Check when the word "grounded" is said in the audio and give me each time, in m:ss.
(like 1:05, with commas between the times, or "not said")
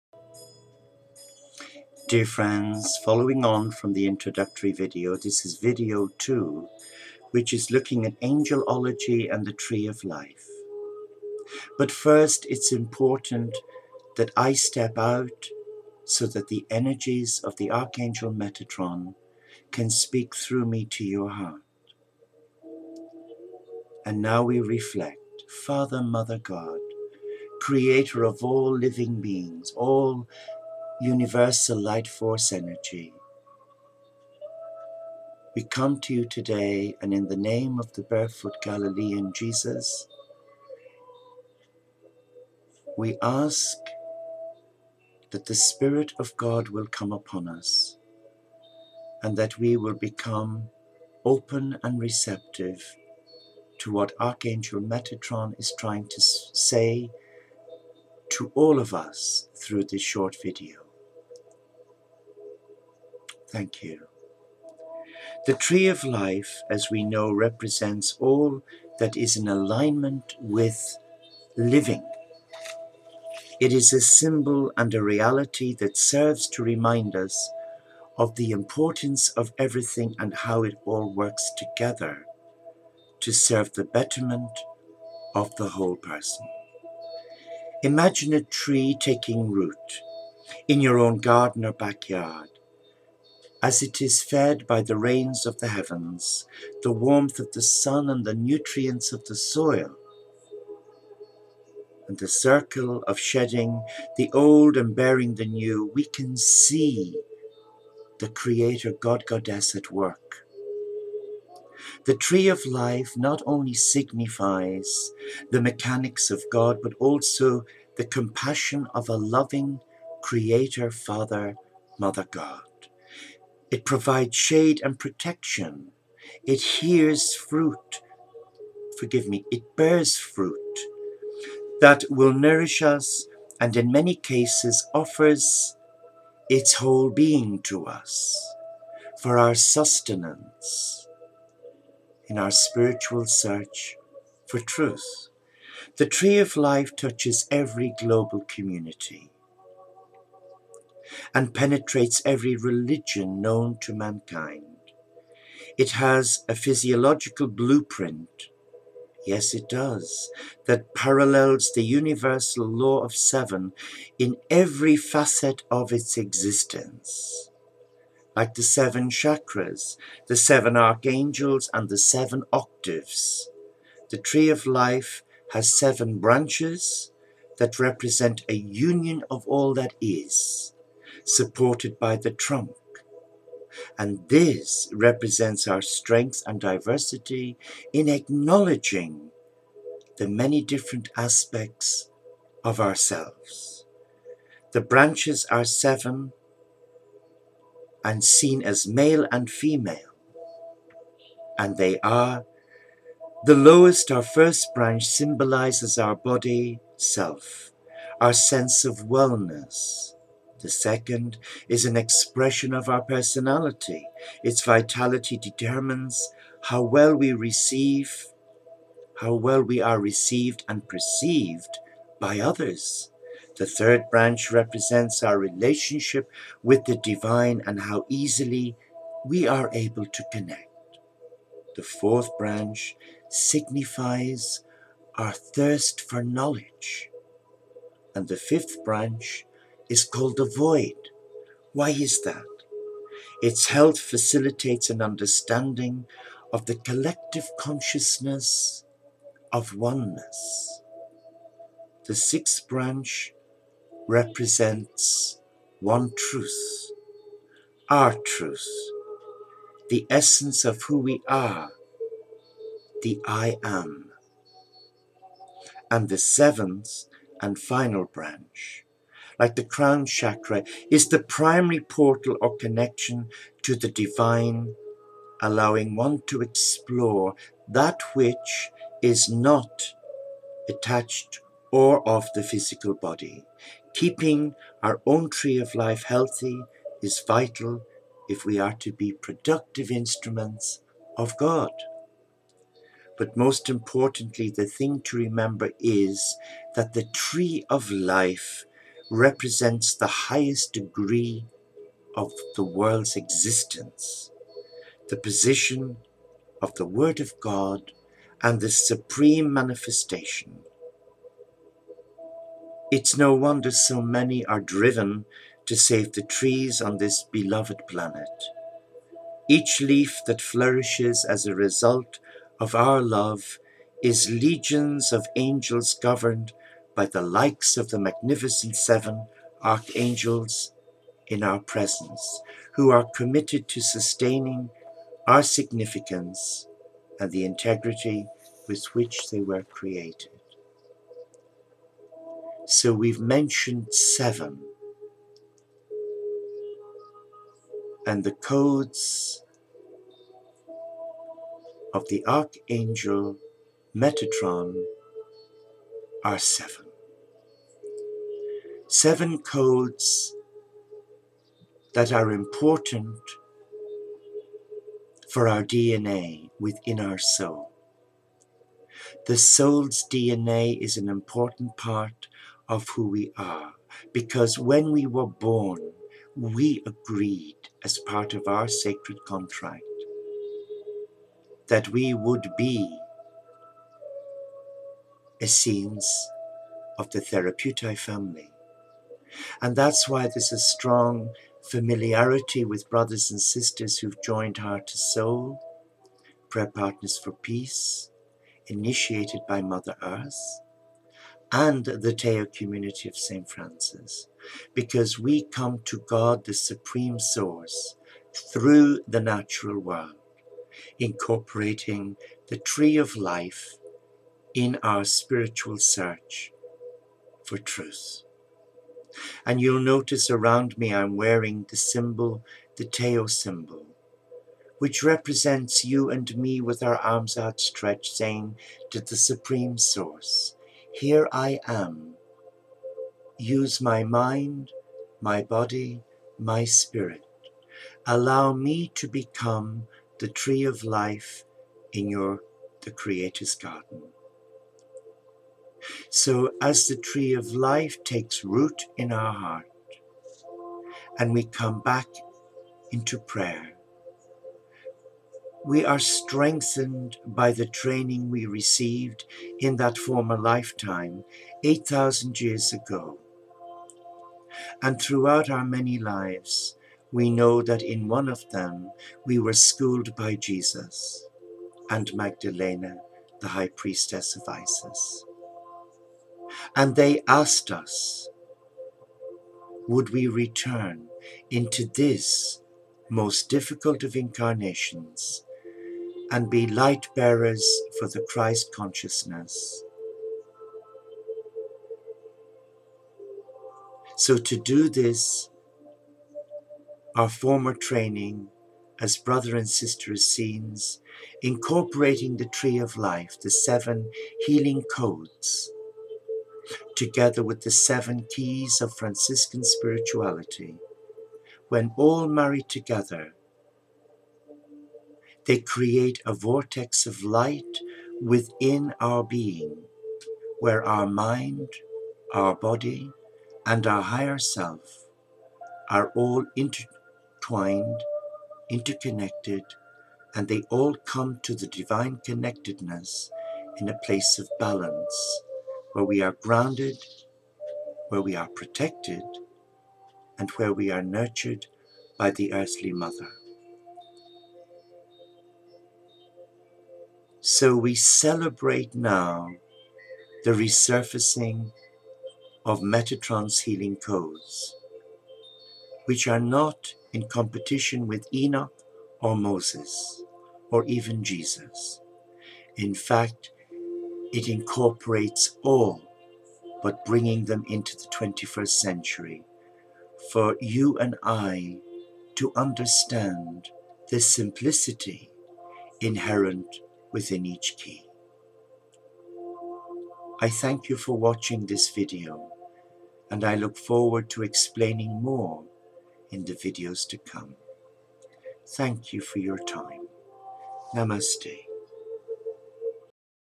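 8:56.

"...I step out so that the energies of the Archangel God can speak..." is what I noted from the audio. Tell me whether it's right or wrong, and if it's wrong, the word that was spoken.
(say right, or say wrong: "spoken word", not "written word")
wrong: "Metatron", not "God".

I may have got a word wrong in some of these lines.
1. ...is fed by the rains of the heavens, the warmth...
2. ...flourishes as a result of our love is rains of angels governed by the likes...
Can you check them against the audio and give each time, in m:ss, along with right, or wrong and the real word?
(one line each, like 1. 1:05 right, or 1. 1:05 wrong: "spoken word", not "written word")
1. 1:34 right
2. 5:20 wrong: "legions", not "rains".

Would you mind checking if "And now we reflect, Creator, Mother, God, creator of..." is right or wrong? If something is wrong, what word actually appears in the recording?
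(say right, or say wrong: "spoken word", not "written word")
wrong: "Father", not "Creator".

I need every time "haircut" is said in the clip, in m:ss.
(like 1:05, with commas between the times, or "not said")
not said.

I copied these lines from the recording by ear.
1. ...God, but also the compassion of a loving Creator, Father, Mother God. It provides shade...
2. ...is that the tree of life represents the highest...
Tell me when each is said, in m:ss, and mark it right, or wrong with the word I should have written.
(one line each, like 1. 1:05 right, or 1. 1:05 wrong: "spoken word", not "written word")
1. 1:56 right
2. 4:55 right.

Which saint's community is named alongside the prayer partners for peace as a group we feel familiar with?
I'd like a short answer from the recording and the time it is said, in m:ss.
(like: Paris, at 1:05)
St. Francis, at 6:43.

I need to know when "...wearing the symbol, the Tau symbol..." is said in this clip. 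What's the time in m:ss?
7:01.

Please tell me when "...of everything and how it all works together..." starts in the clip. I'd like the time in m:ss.
1:19.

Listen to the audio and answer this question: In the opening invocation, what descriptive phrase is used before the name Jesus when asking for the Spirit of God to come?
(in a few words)
barefoot Galilean.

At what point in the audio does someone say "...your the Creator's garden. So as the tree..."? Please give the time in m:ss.
7:22.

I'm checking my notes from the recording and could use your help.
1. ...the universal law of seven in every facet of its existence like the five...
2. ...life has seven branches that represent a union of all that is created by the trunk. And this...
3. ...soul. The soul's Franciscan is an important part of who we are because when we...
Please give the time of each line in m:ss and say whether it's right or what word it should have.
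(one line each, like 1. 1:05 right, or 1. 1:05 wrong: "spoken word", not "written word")
1. 2:41 wrong: "seven", not "five"
2. 2:54 wrong: "supported", not "created"
3. 6:07 wrong: "DNA", not "Franciscan".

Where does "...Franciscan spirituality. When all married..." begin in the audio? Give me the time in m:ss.
8:28.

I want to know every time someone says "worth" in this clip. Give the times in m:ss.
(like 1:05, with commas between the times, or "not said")
not said.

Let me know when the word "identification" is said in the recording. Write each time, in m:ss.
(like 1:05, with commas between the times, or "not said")
not said.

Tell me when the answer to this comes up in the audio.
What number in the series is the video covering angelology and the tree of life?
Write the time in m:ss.
0:05.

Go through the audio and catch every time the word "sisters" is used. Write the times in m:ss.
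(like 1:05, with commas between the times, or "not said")
6:33, 8:19.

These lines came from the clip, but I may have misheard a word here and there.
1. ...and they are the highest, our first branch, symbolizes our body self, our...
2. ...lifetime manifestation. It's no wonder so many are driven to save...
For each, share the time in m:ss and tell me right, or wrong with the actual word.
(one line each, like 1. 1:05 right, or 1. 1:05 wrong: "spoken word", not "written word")
1. 3:21 wrong: "lowest", not "highest"
2. 5:08 wrong: "supreme", not "lifetime".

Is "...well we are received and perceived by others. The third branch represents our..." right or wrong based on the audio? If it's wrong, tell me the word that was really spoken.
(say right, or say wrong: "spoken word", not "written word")
right.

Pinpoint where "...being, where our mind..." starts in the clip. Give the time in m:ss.
8:39.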